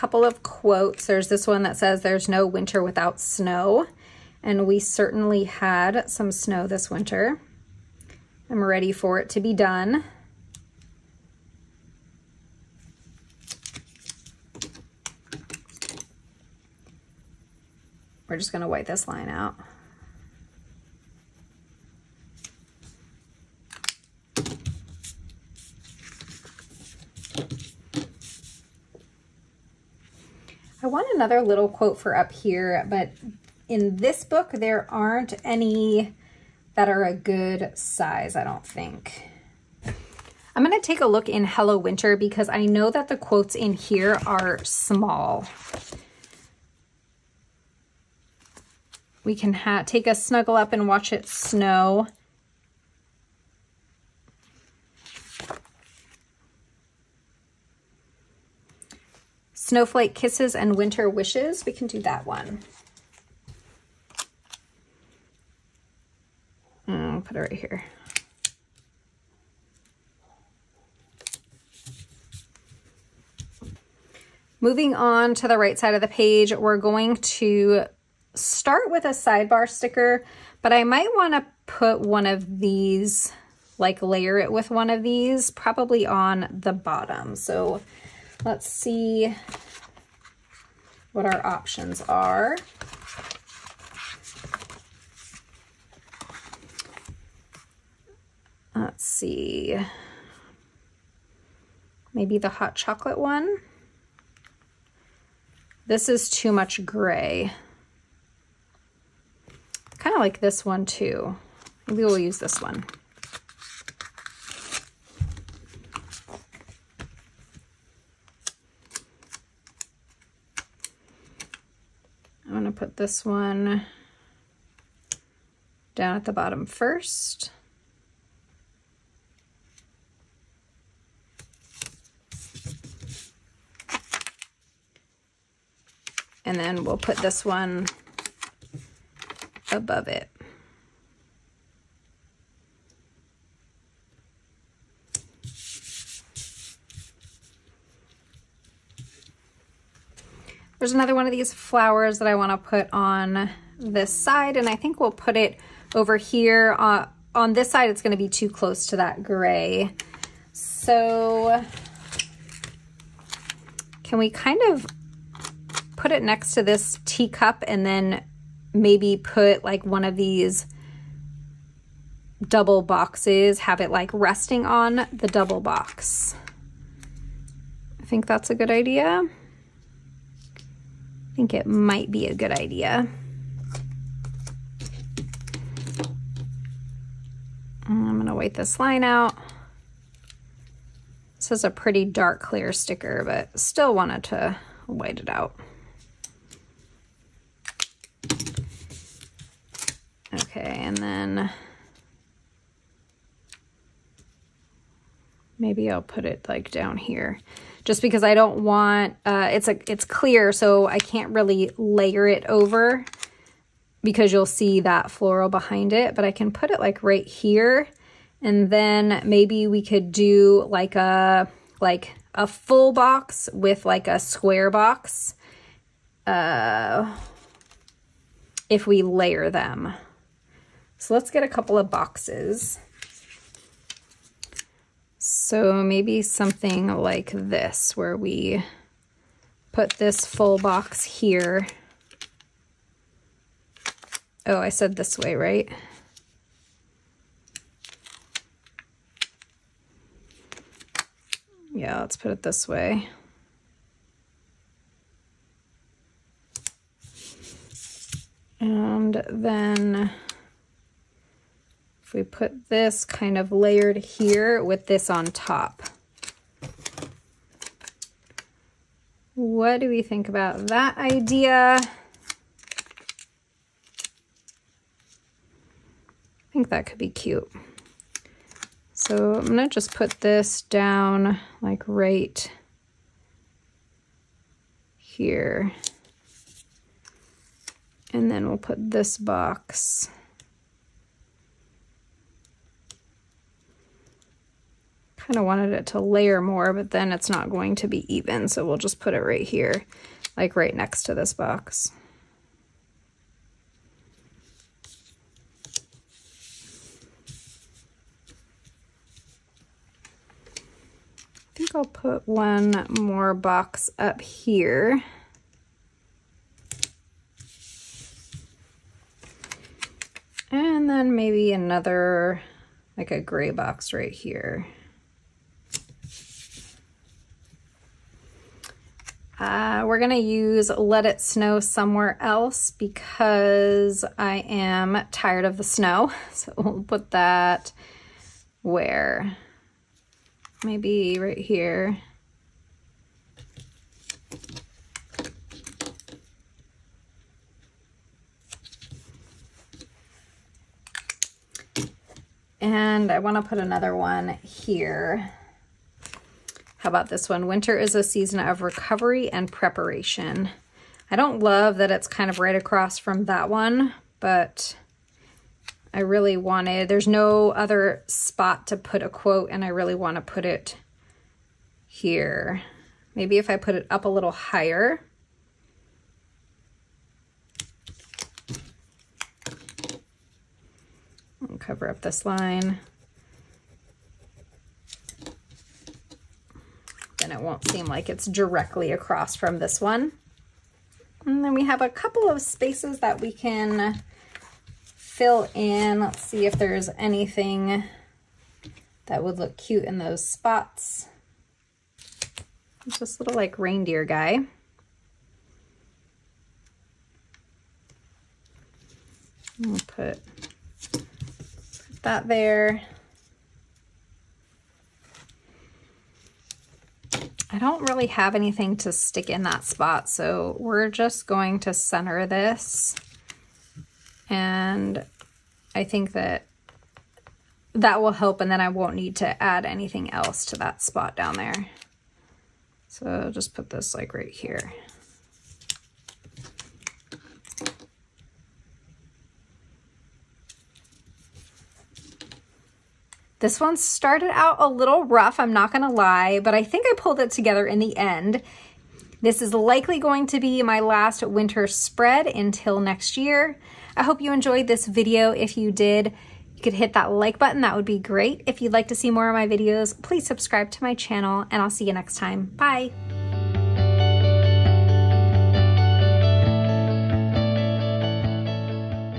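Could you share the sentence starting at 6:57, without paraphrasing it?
I don't really have anything to stick in that spot, so we're just going to center this.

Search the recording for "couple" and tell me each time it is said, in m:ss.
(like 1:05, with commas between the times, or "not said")
3:51, 6:31.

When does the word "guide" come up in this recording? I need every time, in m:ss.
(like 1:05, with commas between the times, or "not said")
not said.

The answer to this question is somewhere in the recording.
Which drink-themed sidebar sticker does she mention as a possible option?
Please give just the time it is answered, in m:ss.
1:42.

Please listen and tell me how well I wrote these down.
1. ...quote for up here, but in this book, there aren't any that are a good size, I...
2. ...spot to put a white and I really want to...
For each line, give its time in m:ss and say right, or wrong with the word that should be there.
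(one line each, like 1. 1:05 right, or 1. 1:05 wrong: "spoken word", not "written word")
1. 0:31 right
2. 6:08 wrong: "quote", not "white".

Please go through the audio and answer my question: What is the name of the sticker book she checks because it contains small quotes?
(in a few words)
Hello Winter.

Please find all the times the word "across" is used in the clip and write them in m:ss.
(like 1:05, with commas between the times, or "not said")
6:02, 6:28.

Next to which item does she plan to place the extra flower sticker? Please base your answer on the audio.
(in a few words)
Teacup.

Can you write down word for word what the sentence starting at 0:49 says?
We can take a snuggle up and watch it snow.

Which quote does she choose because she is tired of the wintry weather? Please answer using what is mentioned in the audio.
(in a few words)
Let It Snow Somewhere Else.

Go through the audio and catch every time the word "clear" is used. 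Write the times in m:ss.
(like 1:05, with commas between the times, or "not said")
3:12, 3:30.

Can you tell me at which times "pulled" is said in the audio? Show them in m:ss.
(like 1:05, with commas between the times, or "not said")
7:26.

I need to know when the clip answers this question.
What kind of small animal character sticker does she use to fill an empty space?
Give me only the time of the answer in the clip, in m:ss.
6:43.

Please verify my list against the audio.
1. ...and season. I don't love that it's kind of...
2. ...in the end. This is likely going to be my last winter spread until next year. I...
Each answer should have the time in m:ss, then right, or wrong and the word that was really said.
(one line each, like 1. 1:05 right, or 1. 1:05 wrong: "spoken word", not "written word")
1. 5:59 wrong: "preparation", not "season"
2. 7:27 right.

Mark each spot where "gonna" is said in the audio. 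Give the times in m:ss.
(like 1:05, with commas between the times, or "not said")
0:18, 0:40, 2:02, 3:08, 4:39, 7:25.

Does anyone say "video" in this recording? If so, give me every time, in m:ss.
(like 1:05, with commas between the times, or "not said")
7:34, 7:39.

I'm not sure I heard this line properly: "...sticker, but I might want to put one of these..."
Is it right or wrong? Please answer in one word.
right.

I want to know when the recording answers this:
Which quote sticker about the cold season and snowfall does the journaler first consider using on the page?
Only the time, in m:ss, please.
0:02.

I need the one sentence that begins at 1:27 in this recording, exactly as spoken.
So let's see what our options are.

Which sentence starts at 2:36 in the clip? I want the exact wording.
Uh, on this side, it's going to be too close to that gray.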